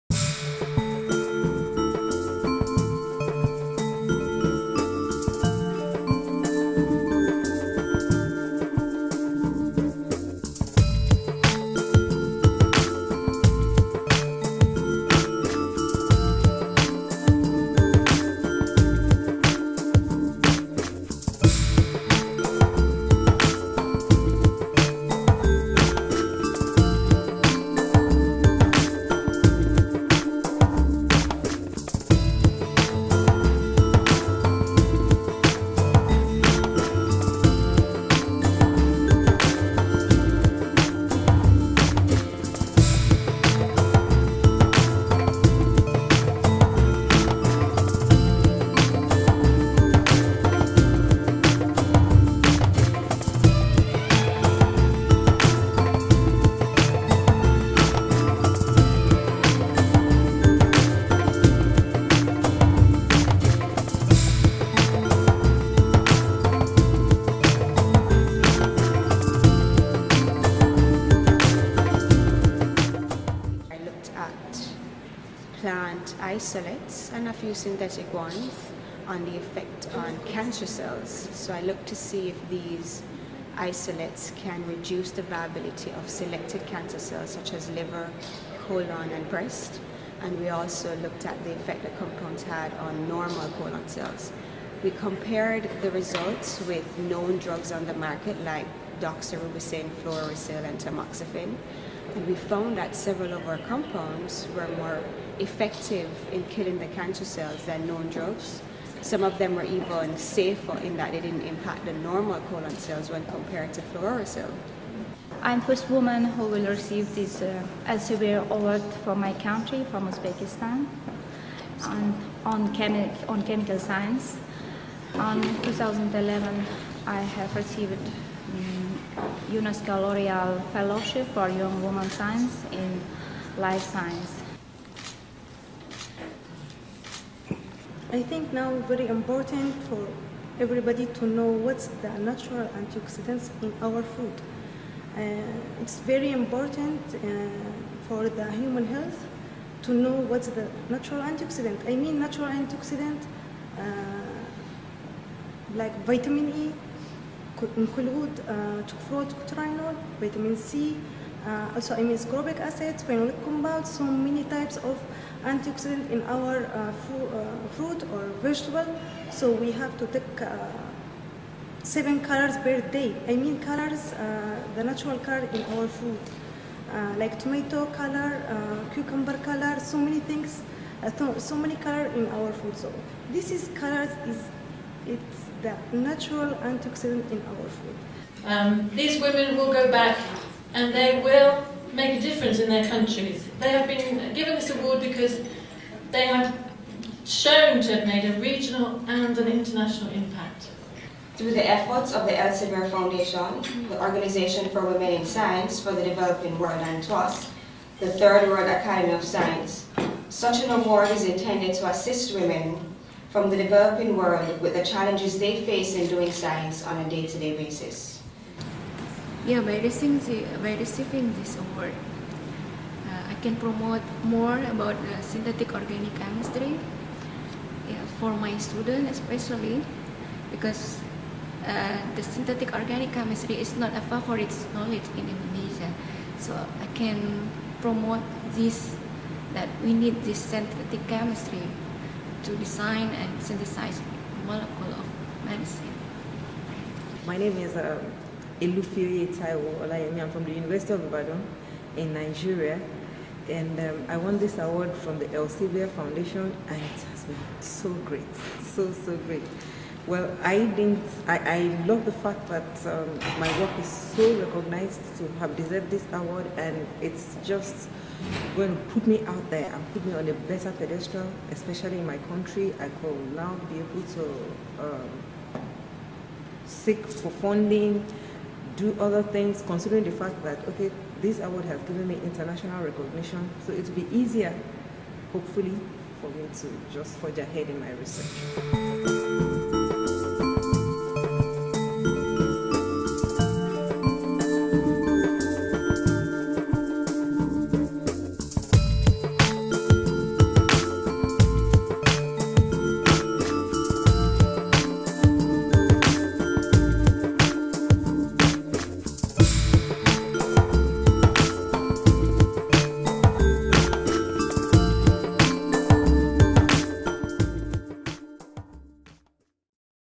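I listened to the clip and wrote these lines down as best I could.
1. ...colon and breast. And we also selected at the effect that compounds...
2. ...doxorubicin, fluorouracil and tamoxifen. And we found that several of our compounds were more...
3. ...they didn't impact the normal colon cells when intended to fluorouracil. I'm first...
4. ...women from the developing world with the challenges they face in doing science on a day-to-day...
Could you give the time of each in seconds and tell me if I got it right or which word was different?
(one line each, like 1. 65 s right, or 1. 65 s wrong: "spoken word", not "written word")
1. 88 s wrong: "looked", not "selected"
2. 99 s right
3. 111 s wrong: "compared", not "intended"
4. 212 s right.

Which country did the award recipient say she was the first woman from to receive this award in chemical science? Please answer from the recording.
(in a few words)
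Uzbekistan.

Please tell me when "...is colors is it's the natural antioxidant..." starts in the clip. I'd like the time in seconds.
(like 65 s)
183 s.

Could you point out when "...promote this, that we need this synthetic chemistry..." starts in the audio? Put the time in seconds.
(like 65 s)
237 s.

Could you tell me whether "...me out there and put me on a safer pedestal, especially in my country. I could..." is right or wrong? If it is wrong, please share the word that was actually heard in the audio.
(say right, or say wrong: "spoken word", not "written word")
wrong: "better", not "safer".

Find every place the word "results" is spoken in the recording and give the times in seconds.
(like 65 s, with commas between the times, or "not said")
95 s.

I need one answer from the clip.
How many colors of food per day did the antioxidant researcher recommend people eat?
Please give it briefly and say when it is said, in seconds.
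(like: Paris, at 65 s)
7, at 171 s.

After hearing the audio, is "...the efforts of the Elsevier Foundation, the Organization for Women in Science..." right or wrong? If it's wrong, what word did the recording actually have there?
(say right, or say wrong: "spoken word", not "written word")
right.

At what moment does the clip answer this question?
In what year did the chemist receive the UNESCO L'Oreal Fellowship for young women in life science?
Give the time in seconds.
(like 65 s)
125 s.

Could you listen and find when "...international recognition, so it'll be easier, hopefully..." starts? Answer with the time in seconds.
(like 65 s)
282 s.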